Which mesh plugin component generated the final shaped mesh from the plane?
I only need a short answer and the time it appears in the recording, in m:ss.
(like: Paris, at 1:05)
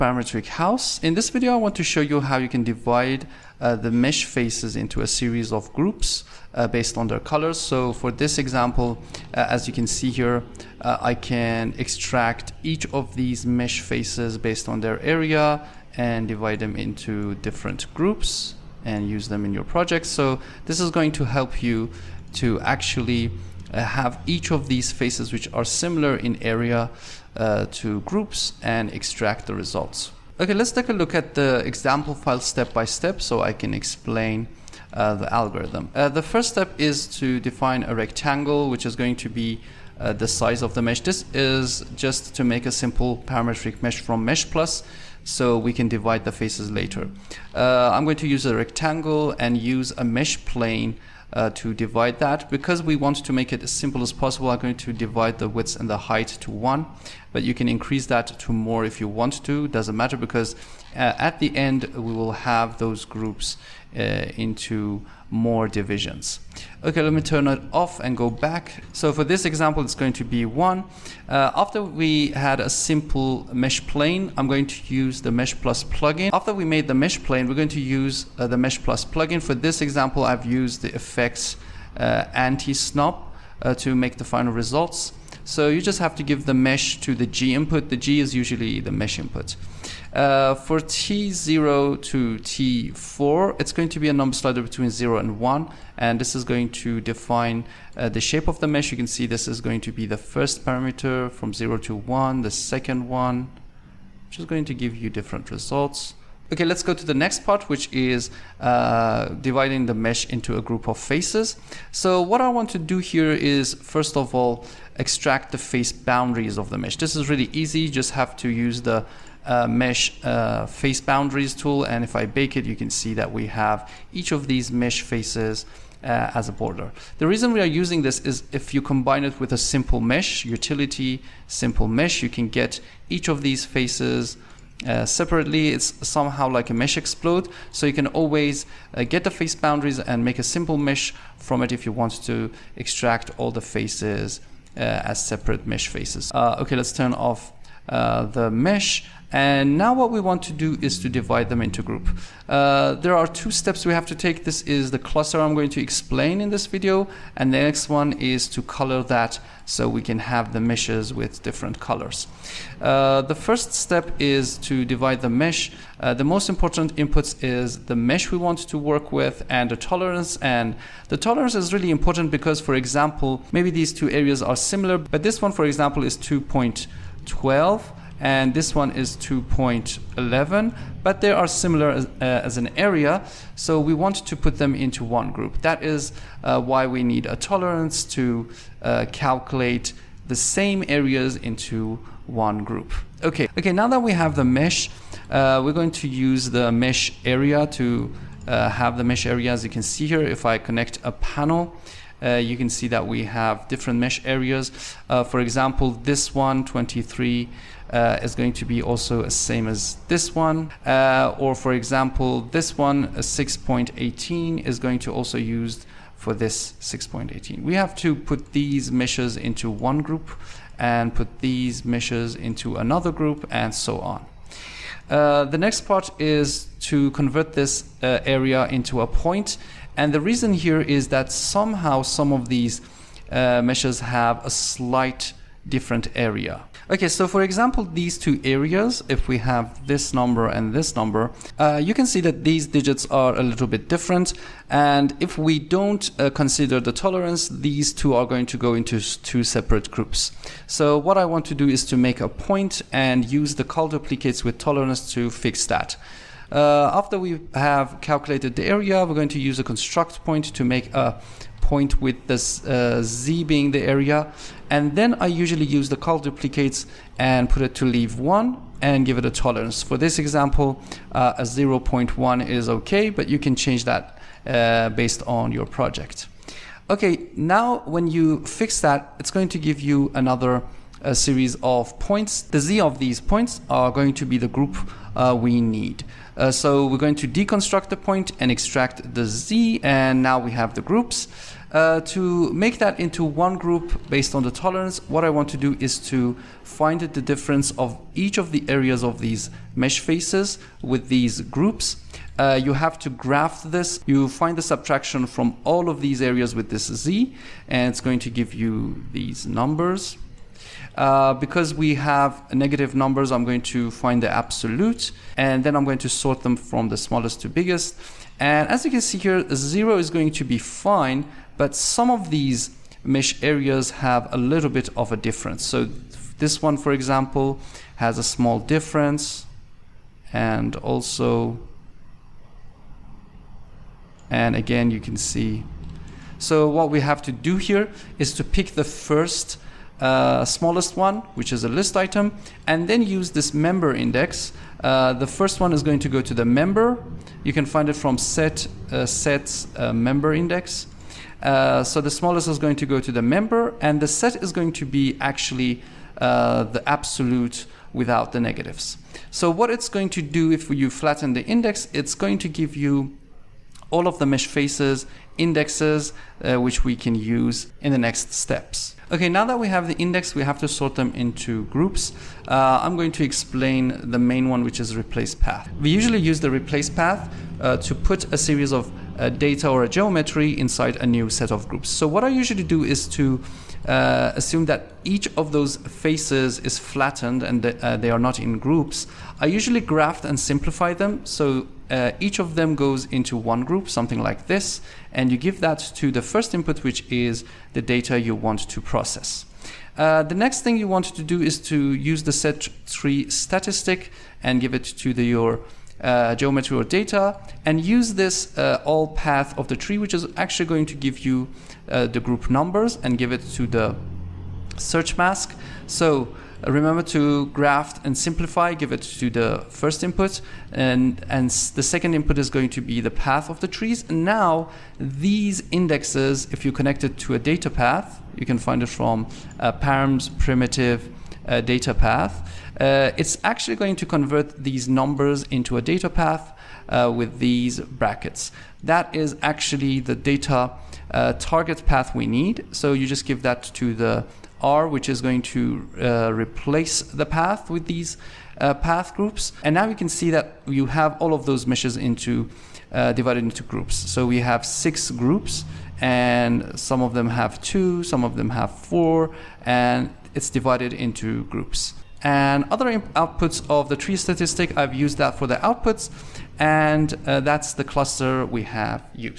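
anti-snop, at 1:22.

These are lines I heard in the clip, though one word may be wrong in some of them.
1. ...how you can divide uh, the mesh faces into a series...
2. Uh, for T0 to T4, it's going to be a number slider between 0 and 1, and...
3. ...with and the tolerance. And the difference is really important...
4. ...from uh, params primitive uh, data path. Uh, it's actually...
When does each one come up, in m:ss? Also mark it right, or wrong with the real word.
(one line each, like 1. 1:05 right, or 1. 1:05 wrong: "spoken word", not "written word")
1. 0:02 right
2. 1:30 right
3. 2:49 wrong: "tolerance", not "difference"
4. 7:08 right.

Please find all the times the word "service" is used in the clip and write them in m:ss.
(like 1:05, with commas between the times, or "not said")
not said.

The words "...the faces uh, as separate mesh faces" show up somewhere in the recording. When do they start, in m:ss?
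2:23.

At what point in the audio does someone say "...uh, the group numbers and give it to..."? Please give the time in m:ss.
6:51.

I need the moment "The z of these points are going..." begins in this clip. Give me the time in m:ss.
4:42.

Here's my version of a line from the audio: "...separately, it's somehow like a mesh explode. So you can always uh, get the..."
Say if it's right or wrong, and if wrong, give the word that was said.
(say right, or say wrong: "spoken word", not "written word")
right.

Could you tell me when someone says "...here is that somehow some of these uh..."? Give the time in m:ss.
3:50.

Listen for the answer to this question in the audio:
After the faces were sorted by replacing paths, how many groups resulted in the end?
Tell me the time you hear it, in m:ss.
7:34.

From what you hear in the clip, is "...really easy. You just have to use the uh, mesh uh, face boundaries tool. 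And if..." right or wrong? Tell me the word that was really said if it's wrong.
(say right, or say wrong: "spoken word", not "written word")
right.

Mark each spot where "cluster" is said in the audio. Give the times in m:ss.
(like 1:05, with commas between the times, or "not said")
2:34, 7:47.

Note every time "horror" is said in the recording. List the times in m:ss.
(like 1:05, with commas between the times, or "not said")
not said.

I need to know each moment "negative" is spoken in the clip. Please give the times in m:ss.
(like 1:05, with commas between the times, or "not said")
5:12, 5:58.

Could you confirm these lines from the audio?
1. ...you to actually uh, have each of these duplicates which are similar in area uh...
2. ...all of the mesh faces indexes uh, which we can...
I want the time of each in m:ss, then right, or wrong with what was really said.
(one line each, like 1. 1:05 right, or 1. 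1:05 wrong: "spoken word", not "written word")
1. 0:21 wrong: "faces", not "duplicates"
2. 6:03 right.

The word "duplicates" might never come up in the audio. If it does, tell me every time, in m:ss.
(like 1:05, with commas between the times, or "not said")
4:13, 4:26.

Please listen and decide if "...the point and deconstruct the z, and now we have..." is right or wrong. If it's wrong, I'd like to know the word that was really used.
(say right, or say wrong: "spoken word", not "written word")
wrong: "extract", not "deconstruct".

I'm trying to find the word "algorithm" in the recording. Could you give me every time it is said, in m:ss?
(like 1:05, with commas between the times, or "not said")
0:35.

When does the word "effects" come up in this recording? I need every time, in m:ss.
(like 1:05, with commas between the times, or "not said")
1:20.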